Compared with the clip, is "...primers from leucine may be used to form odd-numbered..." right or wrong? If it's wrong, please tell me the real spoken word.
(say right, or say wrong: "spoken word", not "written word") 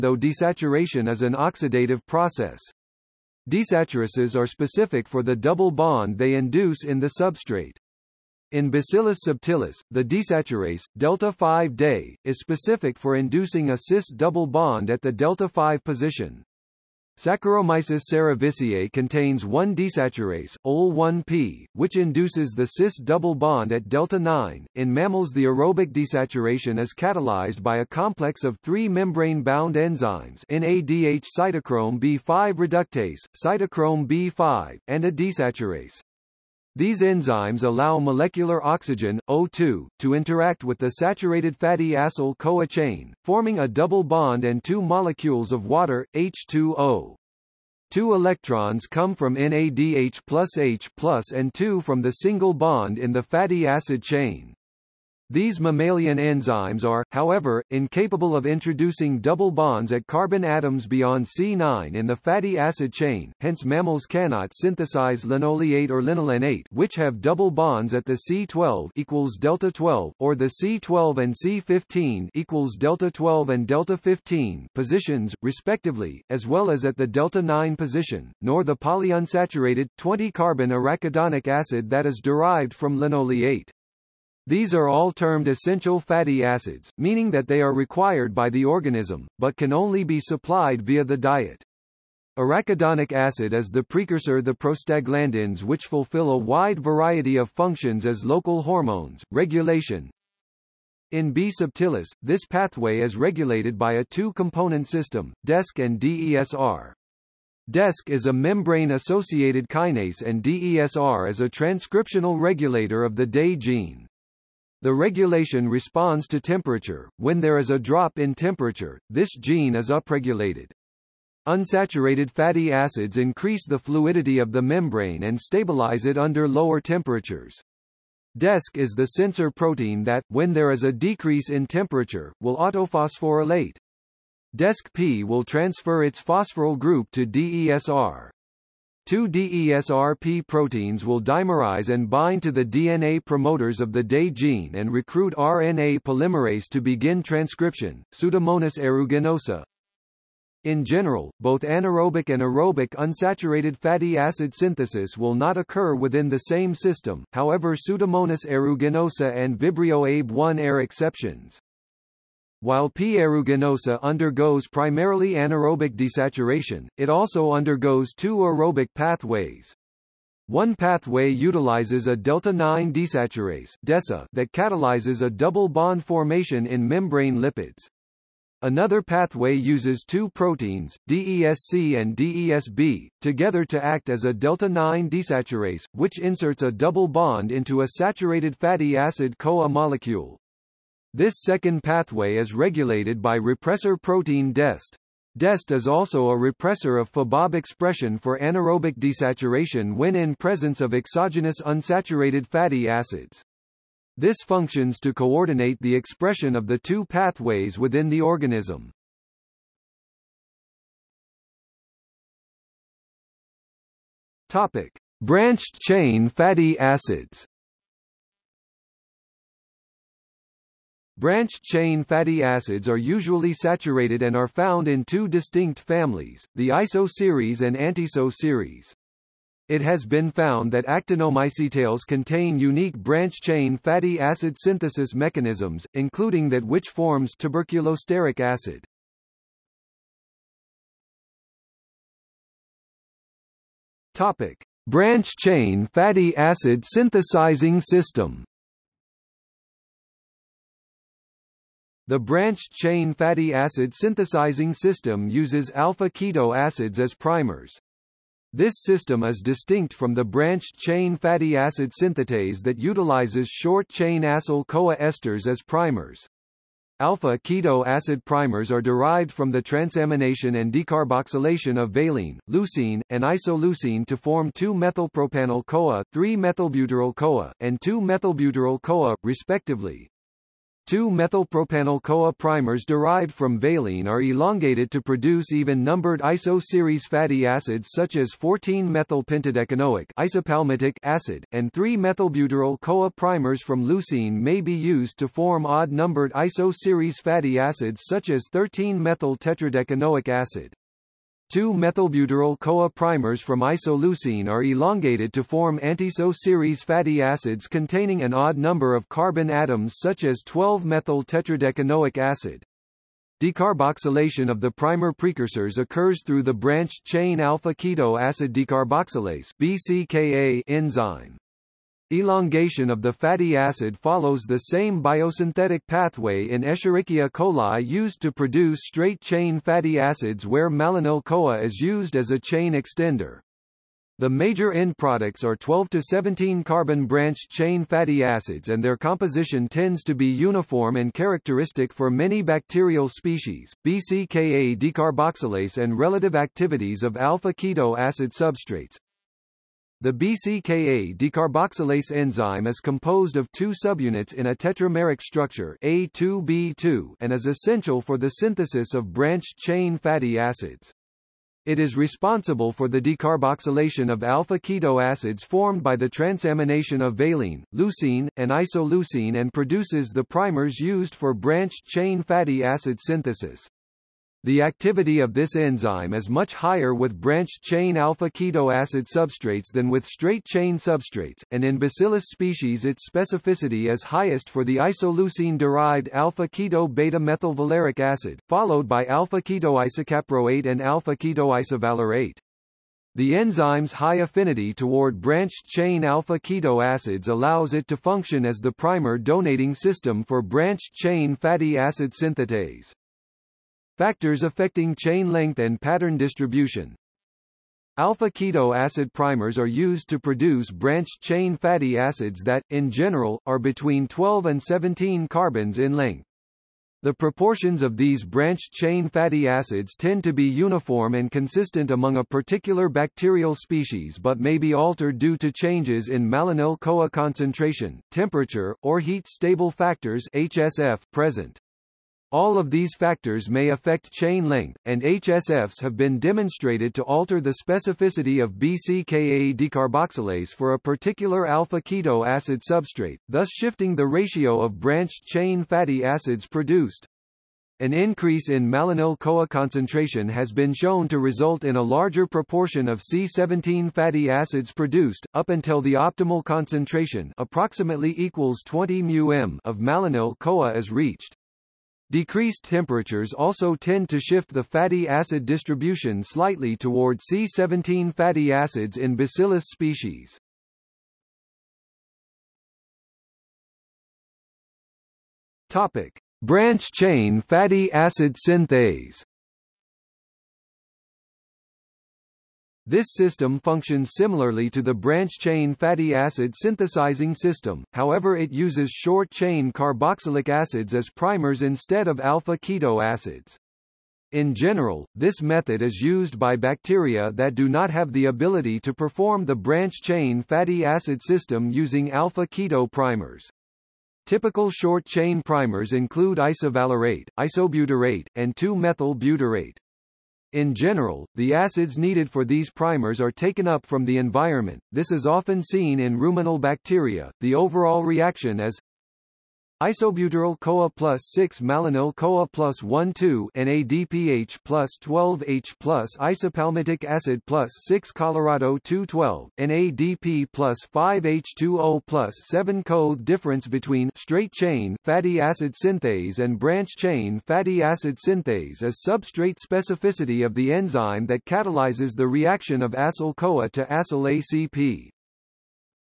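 right.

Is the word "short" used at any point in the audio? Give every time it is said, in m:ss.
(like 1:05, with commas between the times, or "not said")
4:23, 8:08, 8:24.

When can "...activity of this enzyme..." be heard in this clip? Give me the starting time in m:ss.
6:14.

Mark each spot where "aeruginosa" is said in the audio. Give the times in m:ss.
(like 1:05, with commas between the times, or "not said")
2:28, 2:38, 2:43.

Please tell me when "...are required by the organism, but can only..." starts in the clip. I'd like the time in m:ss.
1:27.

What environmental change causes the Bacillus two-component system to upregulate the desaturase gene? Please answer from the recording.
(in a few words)
A drop in temperature.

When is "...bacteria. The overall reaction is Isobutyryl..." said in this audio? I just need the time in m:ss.
8:36.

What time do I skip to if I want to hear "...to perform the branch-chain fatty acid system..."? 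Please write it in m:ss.
8:18.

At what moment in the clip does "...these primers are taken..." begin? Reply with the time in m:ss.
8:32.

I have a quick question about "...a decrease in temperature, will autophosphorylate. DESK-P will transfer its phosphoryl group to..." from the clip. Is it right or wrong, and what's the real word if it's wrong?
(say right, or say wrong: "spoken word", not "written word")
right.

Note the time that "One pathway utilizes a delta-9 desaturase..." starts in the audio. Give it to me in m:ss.
2:50.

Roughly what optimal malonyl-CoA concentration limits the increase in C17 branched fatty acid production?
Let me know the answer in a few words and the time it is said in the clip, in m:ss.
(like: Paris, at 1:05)
20 μM, at 7:38.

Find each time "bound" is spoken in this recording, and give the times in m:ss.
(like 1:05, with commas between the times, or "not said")
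0:28.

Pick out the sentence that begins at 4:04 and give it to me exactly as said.
Topic: Branch-chain fatty acid synthesizing system.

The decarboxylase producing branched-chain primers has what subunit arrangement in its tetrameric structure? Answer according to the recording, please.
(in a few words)
A2B2.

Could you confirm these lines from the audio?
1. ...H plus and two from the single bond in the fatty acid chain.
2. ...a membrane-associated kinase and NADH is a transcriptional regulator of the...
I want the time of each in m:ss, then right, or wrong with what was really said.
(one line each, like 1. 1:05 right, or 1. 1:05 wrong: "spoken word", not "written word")
1. 0:50 right
2. 1:48 wrong: "DESR", not "NADH".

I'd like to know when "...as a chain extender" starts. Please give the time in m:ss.
5:32.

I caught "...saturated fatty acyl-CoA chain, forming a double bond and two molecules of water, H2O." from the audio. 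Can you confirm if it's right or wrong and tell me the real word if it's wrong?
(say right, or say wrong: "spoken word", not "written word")
right.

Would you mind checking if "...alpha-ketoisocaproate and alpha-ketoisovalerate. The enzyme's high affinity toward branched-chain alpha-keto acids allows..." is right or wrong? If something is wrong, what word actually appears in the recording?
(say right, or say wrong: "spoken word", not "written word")
right.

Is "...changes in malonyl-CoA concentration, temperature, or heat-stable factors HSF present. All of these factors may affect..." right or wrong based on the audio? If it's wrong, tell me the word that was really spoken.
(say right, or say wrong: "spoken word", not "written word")
right.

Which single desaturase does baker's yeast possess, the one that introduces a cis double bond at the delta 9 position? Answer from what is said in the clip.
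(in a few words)
OL1P.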